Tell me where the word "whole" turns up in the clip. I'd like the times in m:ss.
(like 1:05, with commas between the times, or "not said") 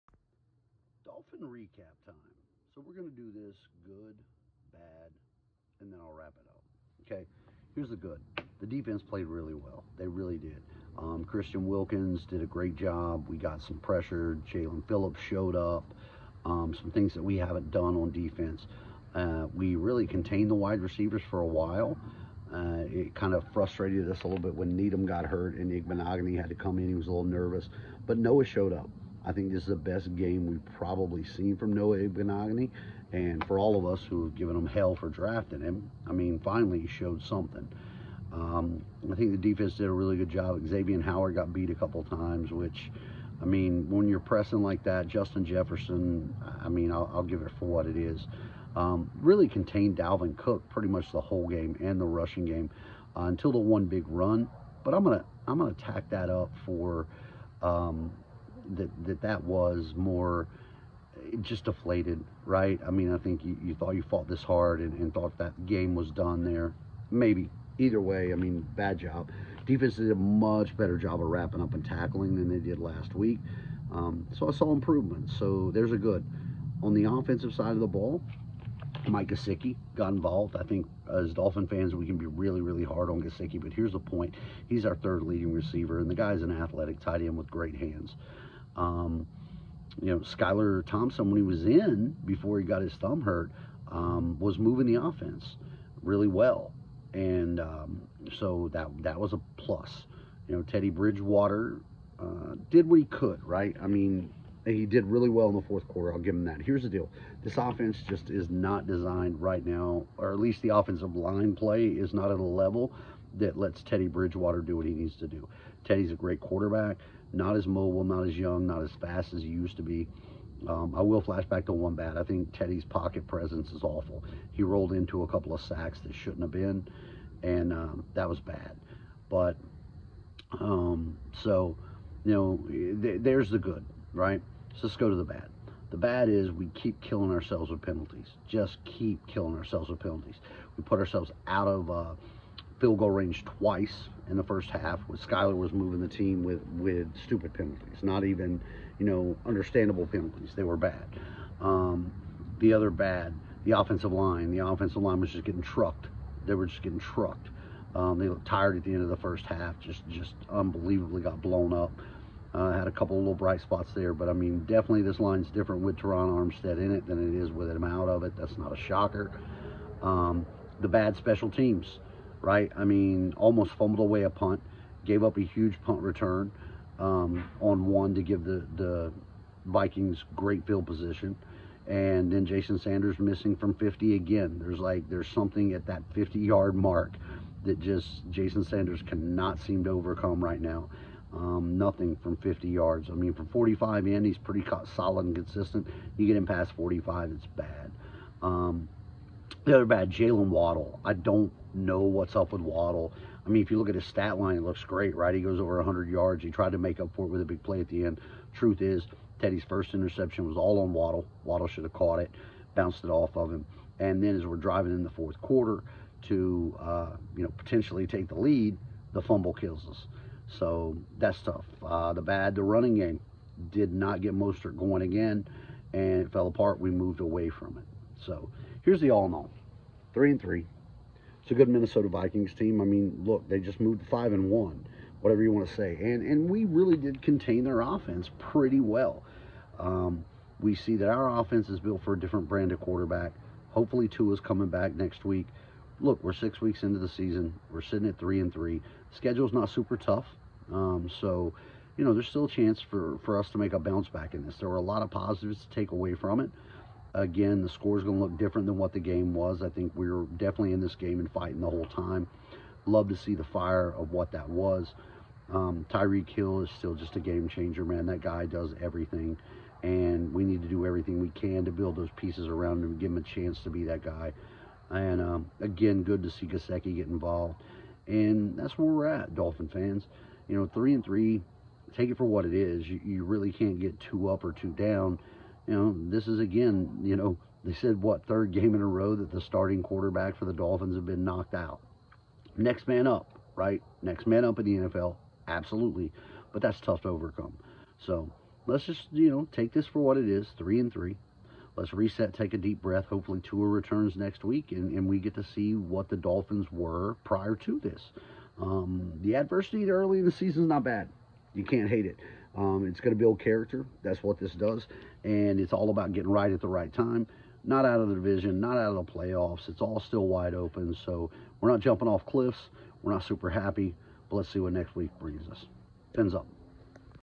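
0:51, 4:21.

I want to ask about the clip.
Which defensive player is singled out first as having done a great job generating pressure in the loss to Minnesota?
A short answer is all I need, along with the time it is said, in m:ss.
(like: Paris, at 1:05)
Christian Wilkins, at 0:11.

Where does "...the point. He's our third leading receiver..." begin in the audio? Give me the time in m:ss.
1:23.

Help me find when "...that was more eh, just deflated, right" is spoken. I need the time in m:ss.
0:59.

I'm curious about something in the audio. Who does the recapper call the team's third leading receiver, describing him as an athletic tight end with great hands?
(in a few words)
Mike Gesicki.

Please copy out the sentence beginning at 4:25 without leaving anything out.
Um, Tyreek Hill is still just a game changer, man.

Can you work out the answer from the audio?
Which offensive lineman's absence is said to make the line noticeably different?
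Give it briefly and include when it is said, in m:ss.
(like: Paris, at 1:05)
Terron Armstead, at 2:45.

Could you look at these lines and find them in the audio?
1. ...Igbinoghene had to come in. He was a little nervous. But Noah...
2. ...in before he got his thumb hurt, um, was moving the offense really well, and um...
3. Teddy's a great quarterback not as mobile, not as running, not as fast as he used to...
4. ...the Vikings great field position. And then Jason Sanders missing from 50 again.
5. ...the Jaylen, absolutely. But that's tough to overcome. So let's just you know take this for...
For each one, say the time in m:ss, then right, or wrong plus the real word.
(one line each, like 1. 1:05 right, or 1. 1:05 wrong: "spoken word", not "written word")
1. 0:25 right
2. 1:31 right
3. 1:55 wrong: "young", not "running"
4. 2:58 right
5. 4:54 wrong: "NFL", not "Jaylen".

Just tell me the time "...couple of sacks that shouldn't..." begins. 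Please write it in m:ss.
2:05.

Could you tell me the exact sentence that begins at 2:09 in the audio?
But um, so, you know, th there's the good, right?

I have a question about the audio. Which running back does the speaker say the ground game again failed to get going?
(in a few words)
Mostert.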